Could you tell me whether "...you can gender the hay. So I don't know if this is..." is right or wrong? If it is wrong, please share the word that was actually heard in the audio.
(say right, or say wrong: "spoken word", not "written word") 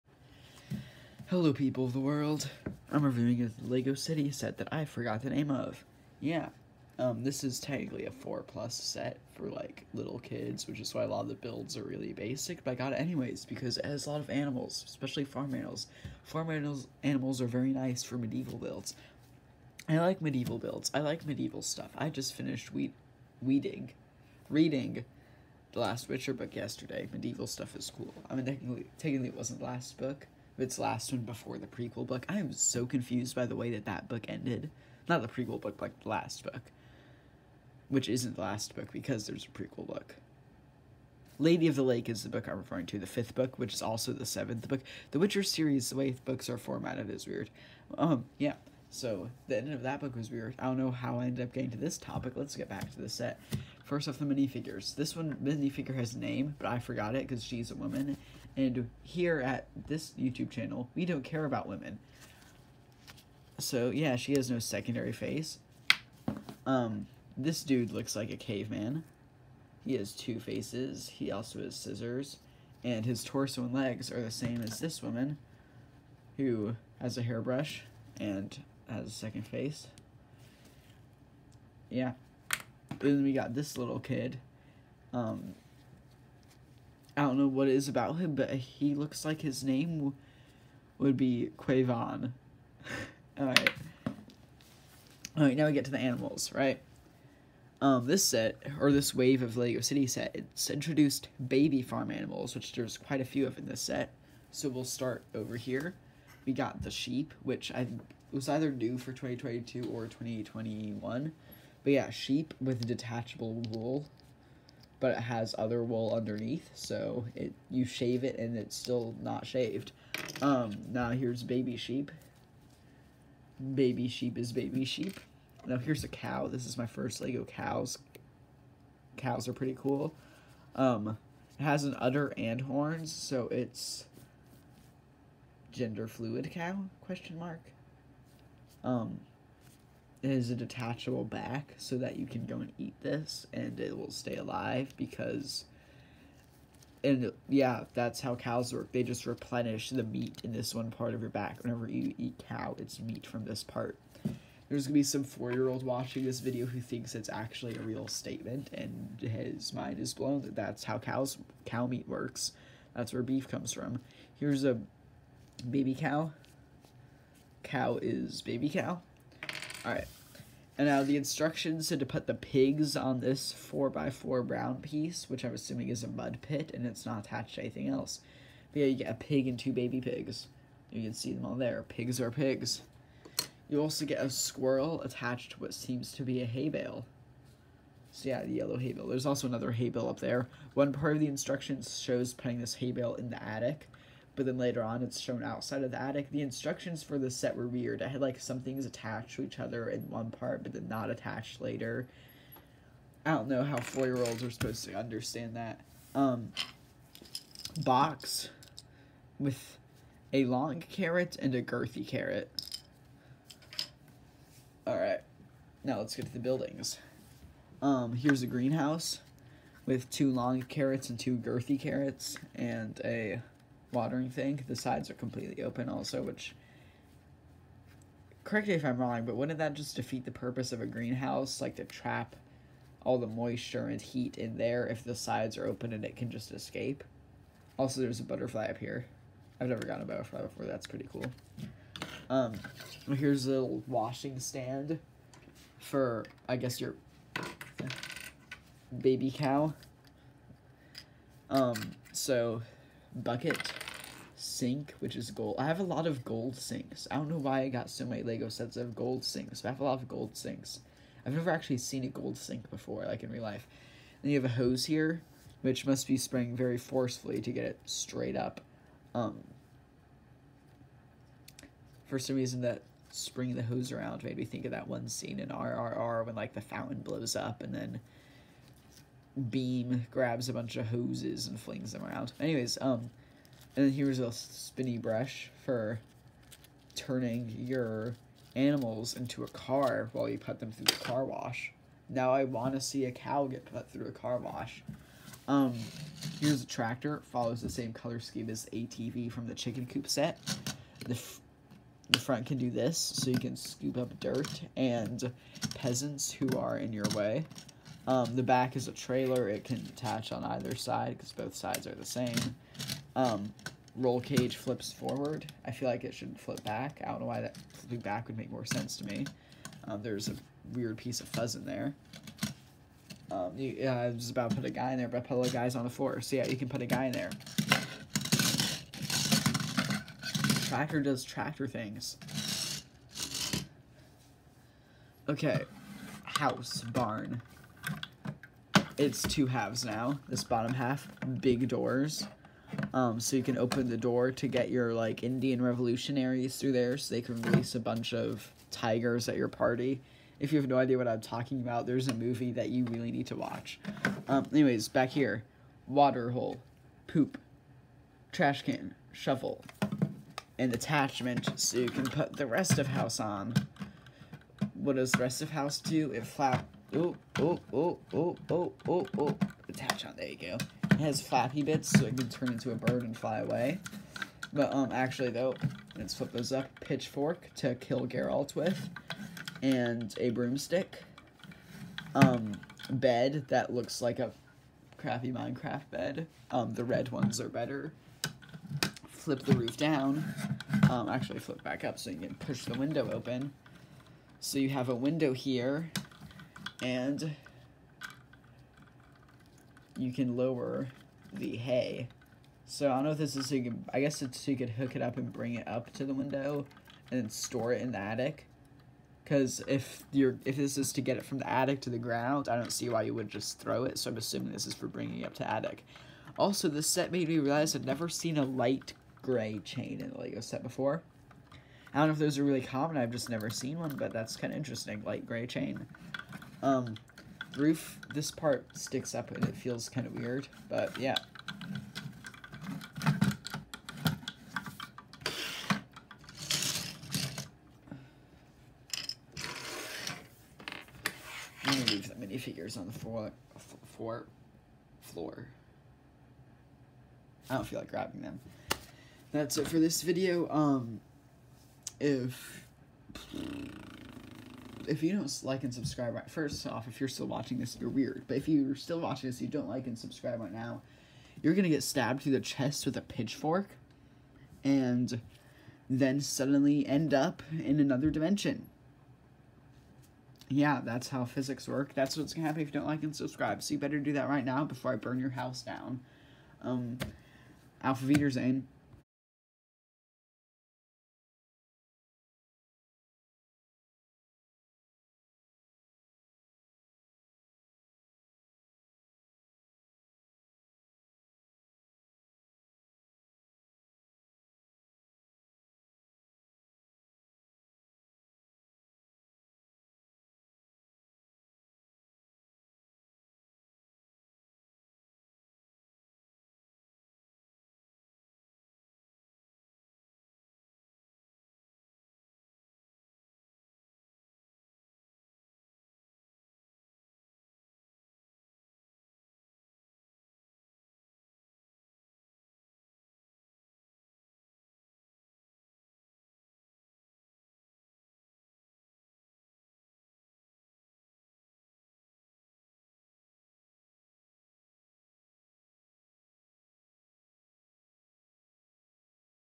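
wrong: "lower", not "gender".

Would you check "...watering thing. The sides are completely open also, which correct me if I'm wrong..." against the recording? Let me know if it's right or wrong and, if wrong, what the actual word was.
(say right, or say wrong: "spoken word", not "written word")
right.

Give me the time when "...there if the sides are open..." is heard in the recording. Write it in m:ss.
3:54.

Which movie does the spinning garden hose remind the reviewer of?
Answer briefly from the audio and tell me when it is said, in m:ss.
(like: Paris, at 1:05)
RRR, at 4:35.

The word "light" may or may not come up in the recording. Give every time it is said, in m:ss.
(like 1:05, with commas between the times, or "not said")
6:58, 7:05.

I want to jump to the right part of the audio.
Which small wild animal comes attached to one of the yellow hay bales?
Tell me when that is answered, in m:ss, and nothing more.
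3:04.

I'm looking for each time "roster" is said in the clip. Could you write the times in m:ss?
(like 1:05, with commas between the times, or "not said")
not said.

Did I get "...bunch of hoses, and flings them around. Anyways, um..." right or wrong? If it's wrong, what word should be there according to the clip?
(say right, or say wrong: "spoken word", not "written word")
right.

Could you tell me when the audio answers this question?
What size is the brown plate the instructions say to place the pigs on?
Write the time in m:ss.
2:53.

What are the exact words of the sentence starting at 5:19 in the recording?
Um, there's a weird piece of fuzz in there.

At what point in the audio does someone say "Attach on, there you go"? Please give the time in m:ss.
6:09.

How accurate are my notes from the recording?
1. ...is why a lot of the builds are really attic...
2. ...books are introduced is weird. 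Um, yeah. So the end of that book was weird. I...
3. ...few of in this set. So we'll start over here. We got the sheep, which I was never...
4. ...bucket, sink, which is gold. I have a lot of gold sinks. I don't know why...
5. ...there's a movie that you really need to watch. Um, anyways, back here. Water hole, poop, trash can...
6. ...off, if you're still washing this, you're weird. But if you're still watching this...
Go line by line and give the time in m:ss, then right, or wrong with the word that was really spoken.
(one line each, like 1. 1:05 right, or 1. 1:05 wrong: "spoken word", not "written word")
1. 0:10 wrong: "basic", not "attic"
2. 0:46 wrong: "formatted", not "introduced"
3. 1:43 wrong: "either", not "never"
4. 4:13 right
5. 5:51 right
6. 7:36 wrong: "watching", not "washing".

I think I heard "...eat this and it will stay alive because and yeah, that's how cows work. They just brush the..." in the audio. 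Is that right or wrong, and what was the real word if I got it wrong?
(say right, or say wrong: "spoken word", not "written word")
wrong: "replenish", not "brush".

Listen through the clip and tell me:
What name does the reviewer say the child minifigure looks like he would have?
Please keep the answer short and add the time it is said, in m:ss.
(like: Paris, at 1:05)
Quavon, at 1:31.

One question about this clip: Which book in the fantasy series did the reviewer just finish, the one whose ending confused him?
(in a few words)
Lady of the Lake.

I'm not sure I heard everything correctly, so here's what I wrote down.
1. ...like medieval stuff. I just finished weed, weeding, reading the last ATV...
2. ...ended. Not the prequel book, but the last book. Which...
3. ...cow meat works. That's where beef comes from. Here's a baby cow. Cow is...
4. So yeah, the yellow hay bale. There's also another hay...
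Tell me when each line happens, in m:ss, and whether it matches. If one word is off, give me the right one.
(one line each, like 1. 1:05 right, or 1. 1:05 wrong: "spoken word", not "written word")
1. 0:20 wrong: "Witcher", not "ATV"
2. 0:34 right
3. 2:41 right
4. 3:08 right.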